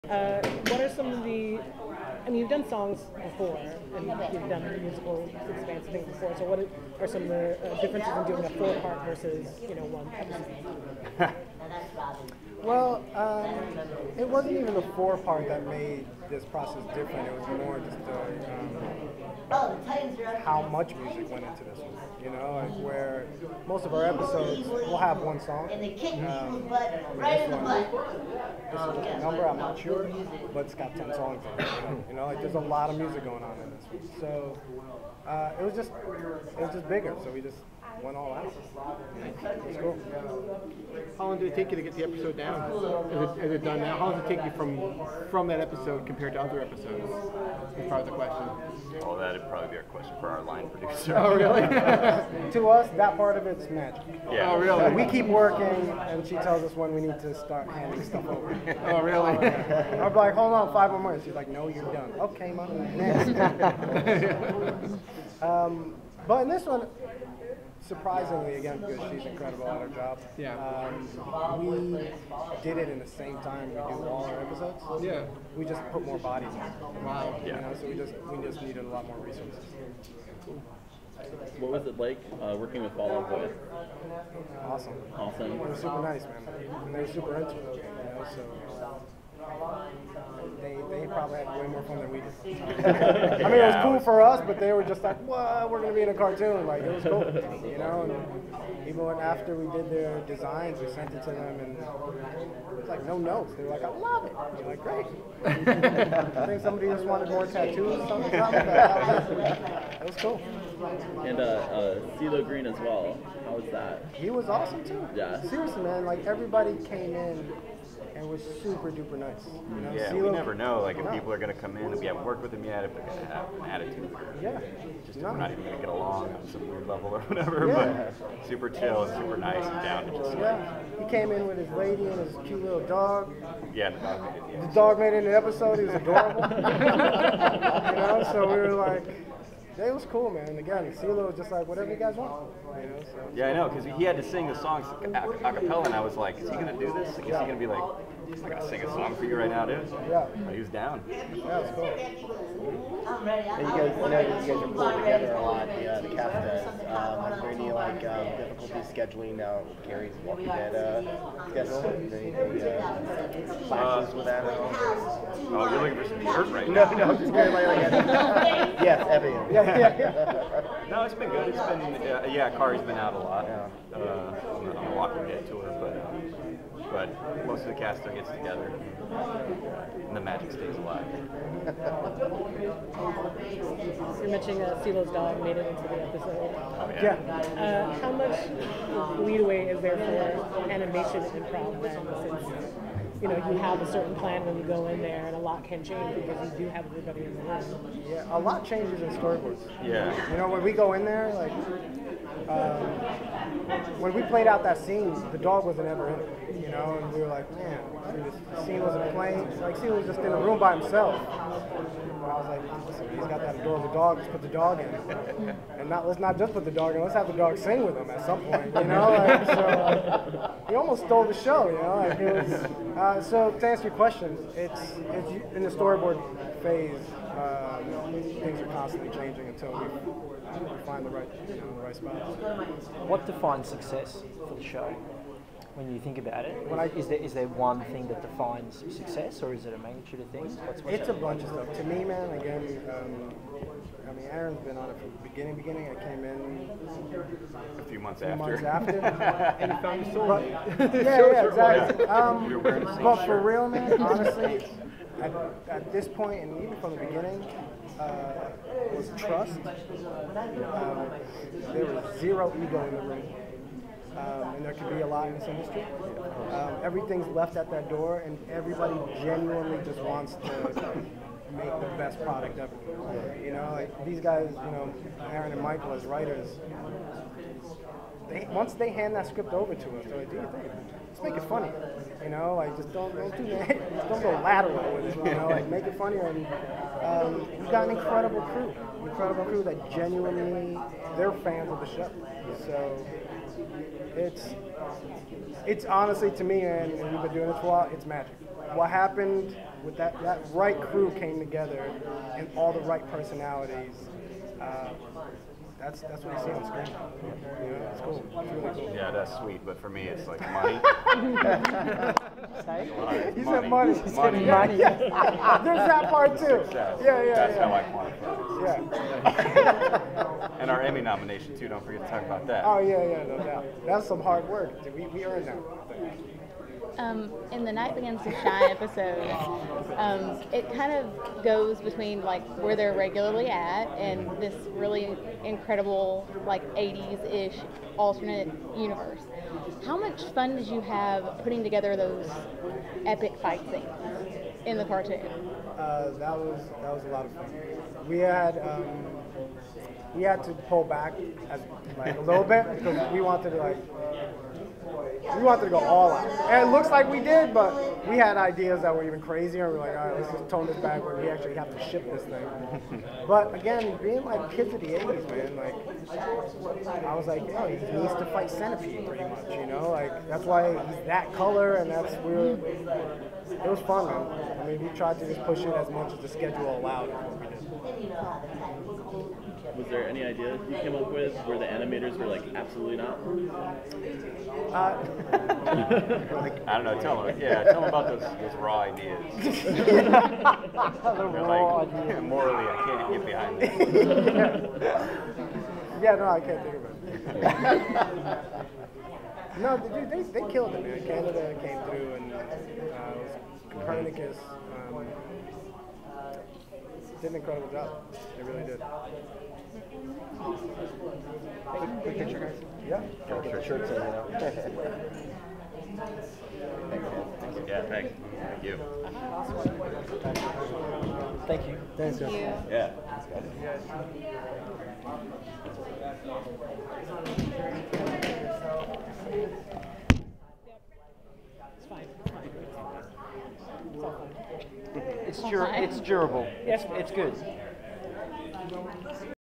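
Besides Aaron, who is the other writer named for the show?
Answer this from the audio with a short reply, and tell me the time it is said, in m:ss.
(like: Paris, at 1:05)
Michael, at 4:35.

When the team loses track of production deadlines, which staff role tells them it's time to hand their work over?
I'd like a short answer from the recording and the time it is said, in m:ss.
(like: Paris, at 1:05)
Line producer, at 0:50.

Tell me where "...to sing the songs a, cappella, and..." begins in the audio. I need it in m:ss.
2:24.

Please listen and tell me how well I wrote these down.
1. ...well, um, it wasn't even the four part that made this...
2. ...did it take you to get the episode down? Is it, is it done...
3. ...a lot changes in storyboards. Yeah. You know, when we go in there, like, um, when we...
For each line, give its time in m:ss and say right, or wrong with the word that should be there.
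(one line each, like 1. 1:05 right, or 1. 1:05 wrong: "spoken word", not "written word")
1. 0:12 right
2. 0:41 right
3. 3:18 right.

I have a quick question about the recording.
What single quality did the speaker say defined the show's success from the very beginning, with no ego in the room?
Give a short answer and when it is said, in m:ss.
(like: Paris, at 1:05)
Trust, at 4:19.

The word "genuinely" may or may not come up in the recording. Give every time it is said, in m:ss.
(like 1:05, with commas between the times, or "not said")
4:29, 4:49.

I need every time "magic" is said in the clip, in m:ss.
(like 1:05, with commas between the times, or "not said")
0:53, 3:00, 4:58.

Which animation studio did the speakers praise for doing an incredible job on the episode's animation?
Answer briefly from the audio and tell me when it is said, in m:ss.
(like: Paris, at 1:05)
Copernicus, at 6:43.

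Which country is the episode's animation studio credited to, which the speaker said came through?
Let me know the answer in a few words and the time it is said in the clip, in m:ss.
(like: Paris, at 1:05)
Canada, at 6:41.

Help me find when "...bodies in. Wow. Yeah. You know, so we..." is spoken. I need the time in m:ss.
1:16.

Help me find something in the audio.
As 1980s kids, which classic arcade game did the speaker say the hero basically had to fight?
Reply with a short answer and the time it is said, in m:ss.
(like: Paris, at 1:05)
Centipede, at 6:08.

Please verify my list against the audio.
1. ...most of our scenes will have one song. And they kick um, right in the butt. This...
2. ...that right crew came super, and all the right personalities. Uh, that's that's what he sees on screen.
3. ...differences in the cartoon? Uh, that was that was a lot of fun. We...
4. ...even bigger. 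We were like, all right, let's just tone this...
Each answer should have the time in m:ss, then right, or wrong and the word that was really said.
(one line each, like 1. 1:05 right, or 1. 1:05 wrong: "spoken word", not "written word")
1. 0:23 wrong: "episodes", not "scenes"
2. 5:00 wrong: "together", not "super"
3. 5:43 wrong: "scenes", not "differences"
4. 5:59 wrong: "crazier", not "bigger".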